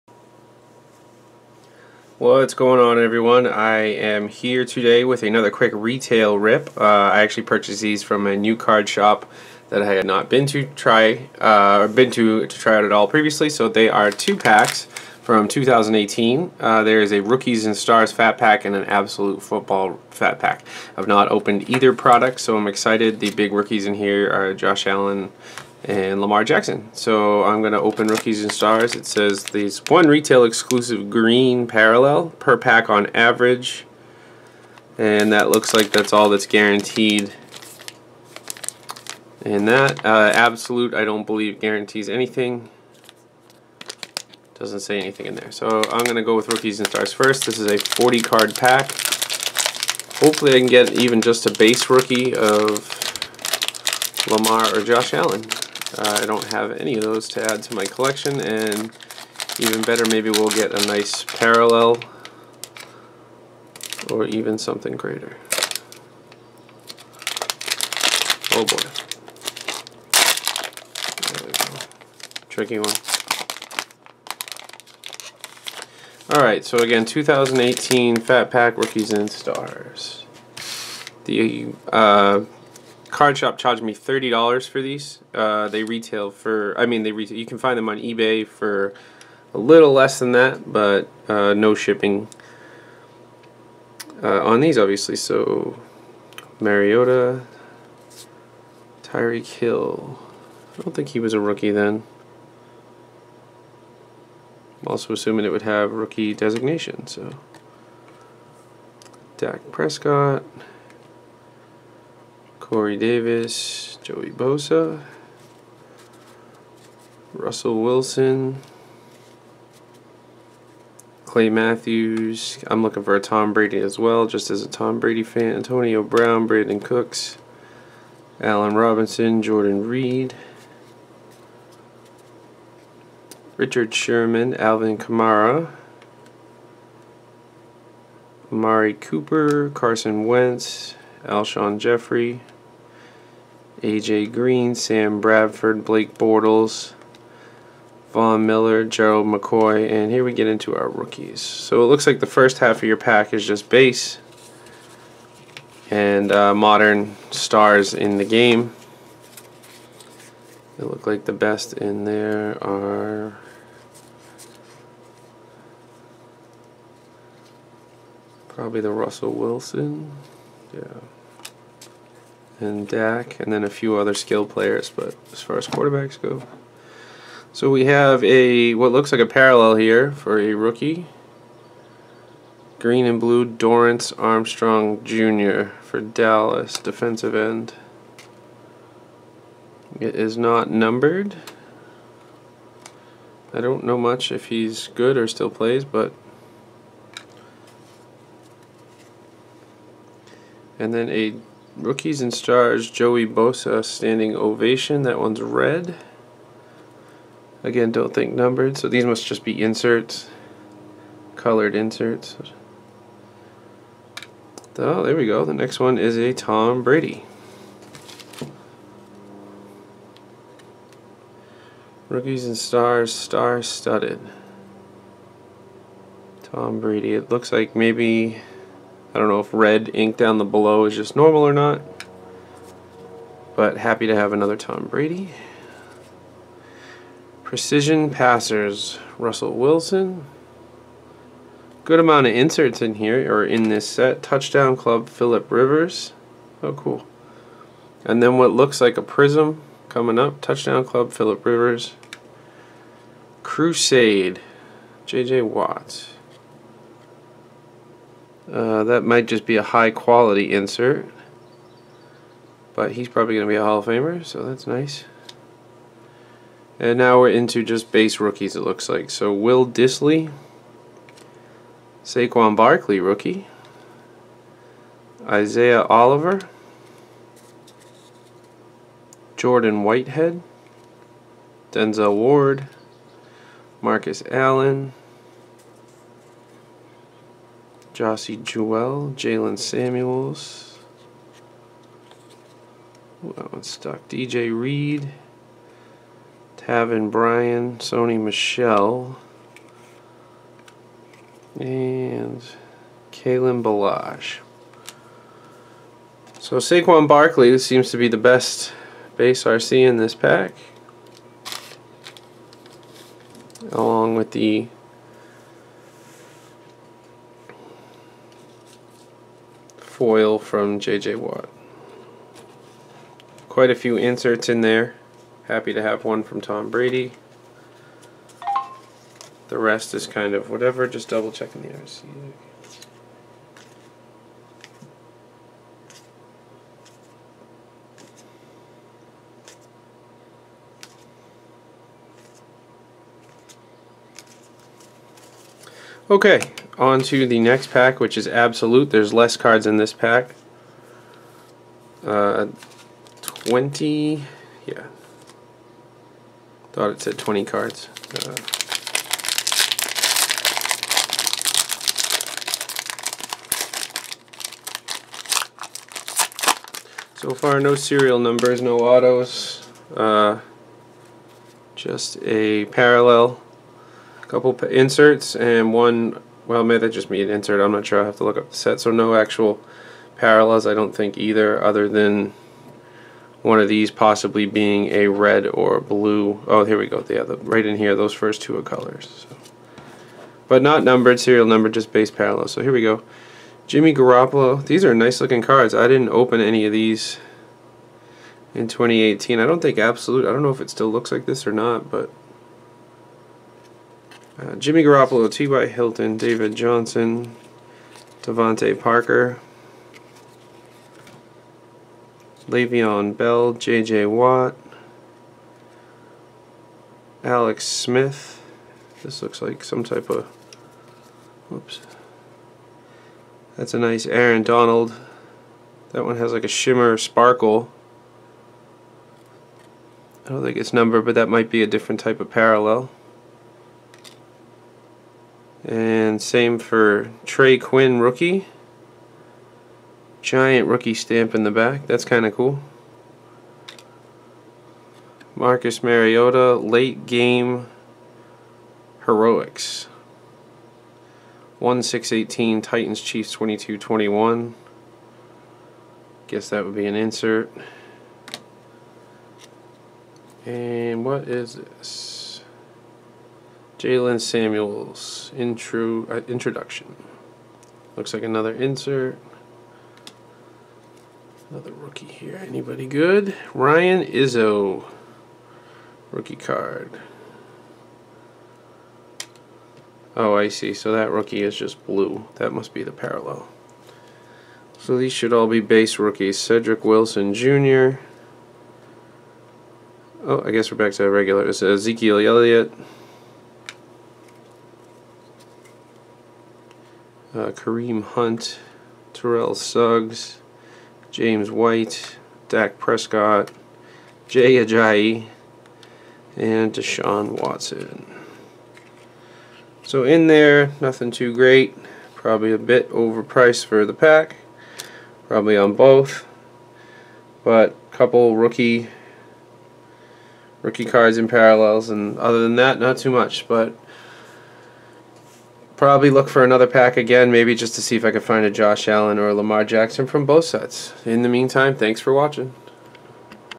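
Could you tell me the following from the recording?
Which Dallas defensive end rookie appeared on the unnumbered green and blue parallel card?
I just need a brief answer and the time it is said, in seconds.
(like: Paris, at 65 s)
Dorance Armstrong Jr., at 183 s.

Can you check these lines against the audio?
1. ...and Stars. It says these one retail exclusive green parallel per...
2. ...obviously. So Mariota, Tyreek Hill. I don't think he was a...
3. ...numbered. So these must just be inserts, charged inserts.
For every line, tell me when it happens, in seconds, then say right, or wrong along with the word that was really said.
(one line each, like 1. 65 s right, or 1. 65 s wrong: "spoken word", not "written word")
1. 28 s right
2. 94 s right
3. 208 s wrong: "colored", not "charged".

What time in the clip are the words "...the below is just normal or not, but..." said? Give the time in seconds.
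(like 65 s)
230 s.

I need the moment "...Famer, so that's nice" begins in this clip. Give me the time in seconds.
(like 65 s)
263 s.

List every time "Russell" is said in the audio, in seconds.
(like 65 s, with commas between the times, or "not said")
117 s, 168 s, 239 s.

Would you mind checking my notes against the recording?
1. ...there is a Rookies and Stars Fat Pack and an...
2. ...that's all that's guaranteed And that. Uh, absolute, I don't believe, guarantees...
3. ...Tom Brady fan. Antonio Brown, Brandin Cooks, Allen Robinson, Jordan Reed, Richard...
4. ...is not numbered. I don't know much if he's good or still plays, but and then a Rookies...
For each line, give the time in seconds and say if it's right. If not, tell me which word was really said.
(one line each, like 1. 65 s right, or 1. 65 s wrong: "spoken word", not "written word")
1. 16 s right
2. 35 s right
3. 124 s right
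4. 190 s right.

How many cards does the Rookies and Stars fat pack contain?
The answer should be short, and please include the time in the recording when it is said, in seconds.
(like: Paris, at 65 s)
40, at 47 s.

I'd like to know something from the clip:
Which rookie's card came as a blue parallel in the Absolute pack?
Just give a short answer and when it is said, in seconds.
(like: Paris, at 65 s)
Ryan Izzo, at 473 s.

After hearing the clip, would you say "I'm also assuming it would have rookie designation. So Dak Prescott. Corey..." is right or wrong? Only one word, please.
right.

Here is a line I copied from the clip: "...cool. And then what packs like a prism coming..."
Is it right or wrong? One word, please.
wrong.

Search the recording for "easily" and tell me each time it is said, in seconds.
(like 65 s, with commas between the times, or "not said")
not said.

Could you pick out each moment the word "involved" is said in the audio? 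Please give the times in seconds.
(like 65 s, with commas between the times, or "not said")
not said.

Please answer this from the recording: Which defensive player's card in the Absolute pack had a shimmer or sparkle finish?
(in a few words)
Aaron Donald.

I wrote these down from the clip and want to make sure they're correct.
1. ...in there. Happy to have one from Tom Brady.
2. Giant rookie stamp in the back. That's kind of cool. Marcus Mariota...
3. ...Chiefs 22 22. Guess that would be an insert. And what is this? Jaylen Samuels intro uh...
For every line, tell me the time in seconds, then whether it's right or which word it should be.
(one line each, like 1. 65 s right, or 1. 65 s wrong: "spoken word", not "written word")
1. 324 s right
2. 440 s right
3. 453 s wrong: "21", not "22".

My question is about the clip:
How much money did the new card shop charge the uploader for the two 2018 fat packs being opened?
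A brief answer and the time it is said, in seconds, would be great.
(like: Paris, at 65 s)
$30, at 83 s.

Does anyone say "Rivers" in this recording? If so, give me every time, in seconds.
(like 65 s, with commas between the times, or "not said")
245 s, 251 s.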